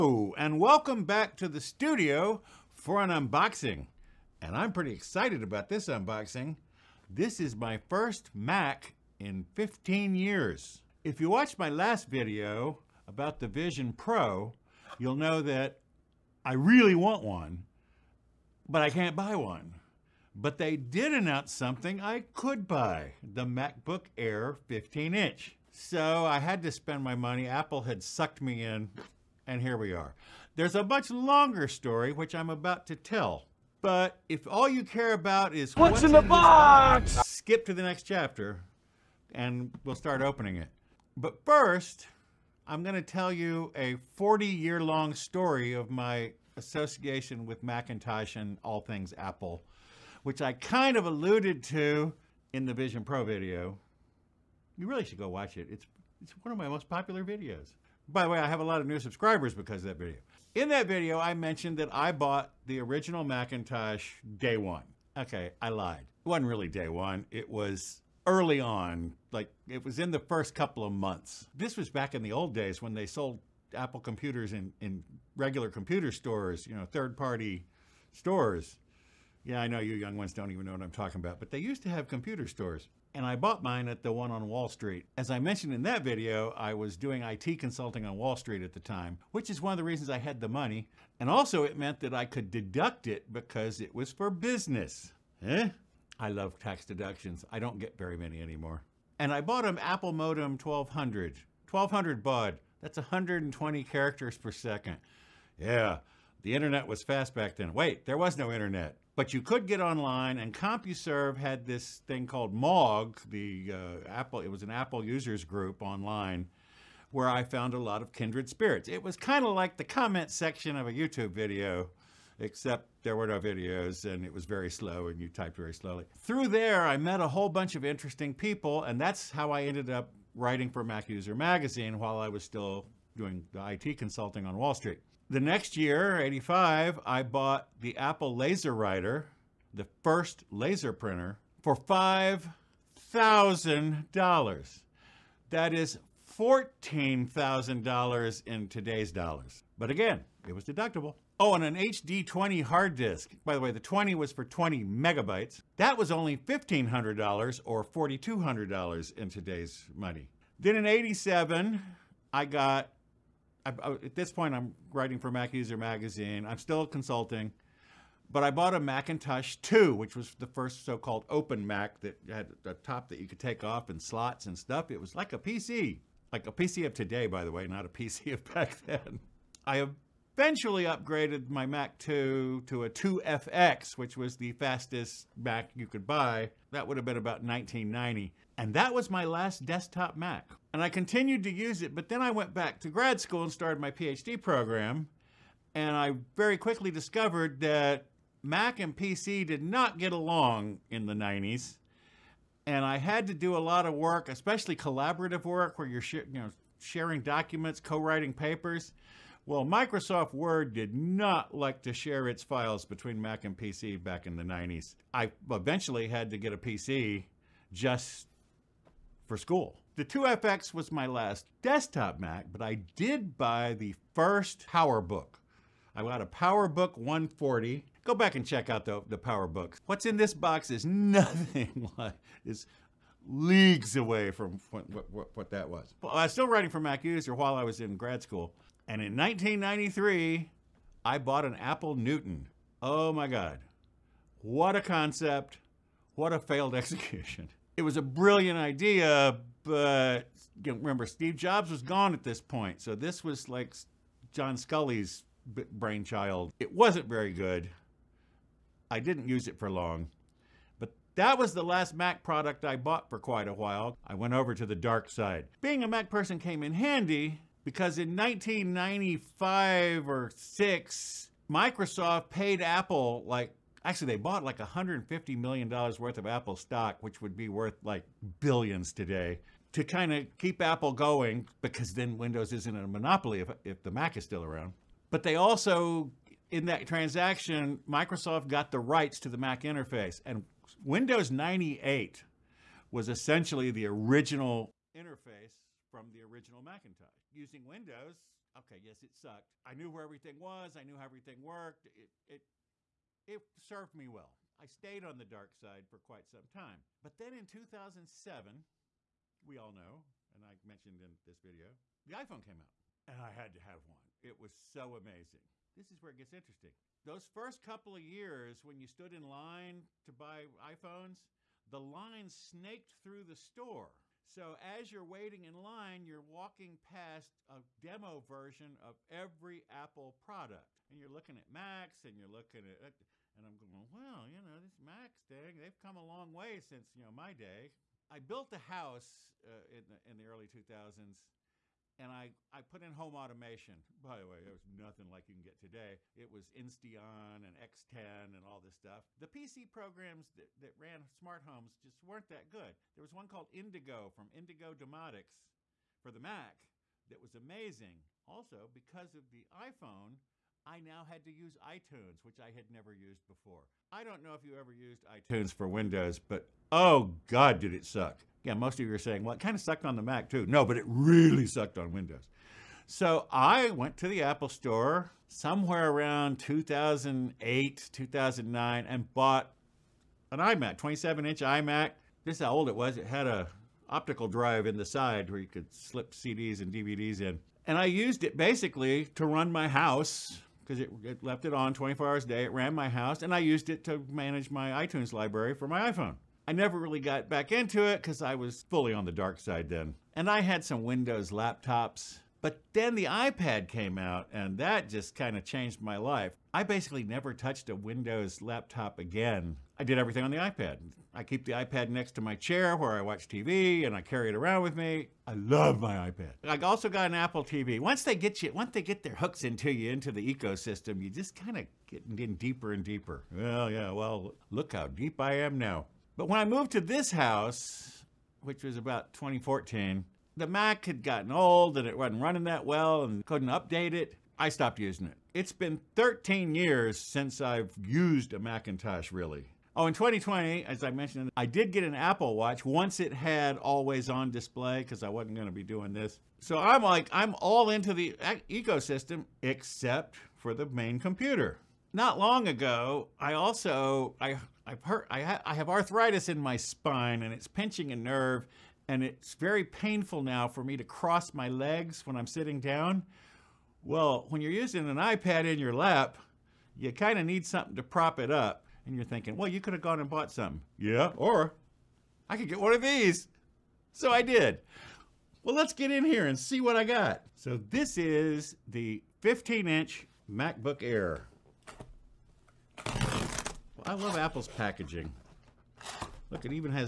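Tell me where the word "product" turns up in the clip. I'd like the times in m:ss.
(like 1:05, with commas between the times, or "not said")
4:22, 5:30.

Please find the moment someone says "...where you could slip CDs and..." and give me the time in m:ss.
6:25.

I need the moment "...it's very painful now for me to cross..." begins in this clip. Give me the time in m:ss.
7:39.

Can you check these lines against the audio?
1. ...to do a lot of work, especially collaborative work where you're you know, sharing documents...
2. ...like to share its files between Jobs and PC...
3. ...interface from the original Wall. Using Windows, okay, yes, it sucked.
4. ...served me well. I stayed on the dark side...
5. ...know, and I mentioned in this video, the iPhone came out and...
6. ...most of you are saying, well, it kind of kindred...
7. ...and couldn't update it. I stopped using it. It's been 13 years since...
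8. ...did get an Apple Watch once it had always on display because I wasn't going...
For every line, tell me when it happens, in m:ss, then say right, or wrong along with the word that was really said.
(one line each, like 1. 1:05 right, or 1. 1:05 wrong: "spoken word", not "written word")
1. 3:23 right
2. 3:31 wrong: "Mac", not "Jobs"
3. 4:54 wrong: "Macintosh", not "Wall"
4. 5:03 right
5. 5:09 right
6. 6:08 wrong: "sucked", not "kindred"
7. 7:13 right
8. 7:21 right.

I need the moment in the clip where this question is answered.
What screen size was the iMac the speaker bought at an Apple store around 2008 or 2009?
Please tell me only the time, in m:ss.
6:20.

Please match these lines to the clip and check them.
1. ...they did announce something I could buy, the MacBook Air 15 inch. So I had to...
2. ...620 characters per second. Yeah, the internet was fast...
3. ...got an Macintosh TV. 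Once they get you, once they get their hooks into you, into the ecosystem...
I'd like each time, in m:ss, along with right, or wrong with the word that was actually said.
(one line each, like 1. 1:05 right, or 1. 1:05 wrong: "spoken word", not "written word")
1. 0:20 right
2. 1:42 wrong: "120", not "620"
3. 6:56 wrong: "Apple", not "Macintosh".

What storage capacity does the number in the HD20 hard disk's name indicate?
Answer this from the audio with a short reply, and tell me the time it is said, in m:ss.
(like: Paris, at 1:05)
20 megabytes, at 2:34.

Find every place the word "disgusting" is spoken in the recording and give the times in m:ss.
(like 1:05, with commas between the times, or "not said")
not said.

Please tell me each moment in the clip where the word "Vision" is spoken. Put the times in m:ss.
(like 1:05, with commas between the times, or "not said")
0:13, 0:52.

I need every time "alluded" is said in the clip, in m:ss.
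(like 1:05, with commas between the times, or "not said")
0:51.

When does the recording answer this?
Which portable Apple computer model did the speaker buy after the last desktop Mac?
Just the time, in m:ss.
3:46.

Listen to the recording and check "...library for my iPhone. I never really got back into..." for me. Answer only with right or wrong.
right.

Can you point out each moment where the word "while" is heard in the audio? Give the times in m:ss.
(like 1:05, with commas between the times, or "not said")
2:11, 3:57, 4:23.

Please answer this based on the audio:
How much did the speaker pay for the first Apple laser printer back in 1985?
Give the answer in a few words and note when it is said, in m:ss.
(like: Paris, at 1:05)
$5,000, at 2:21.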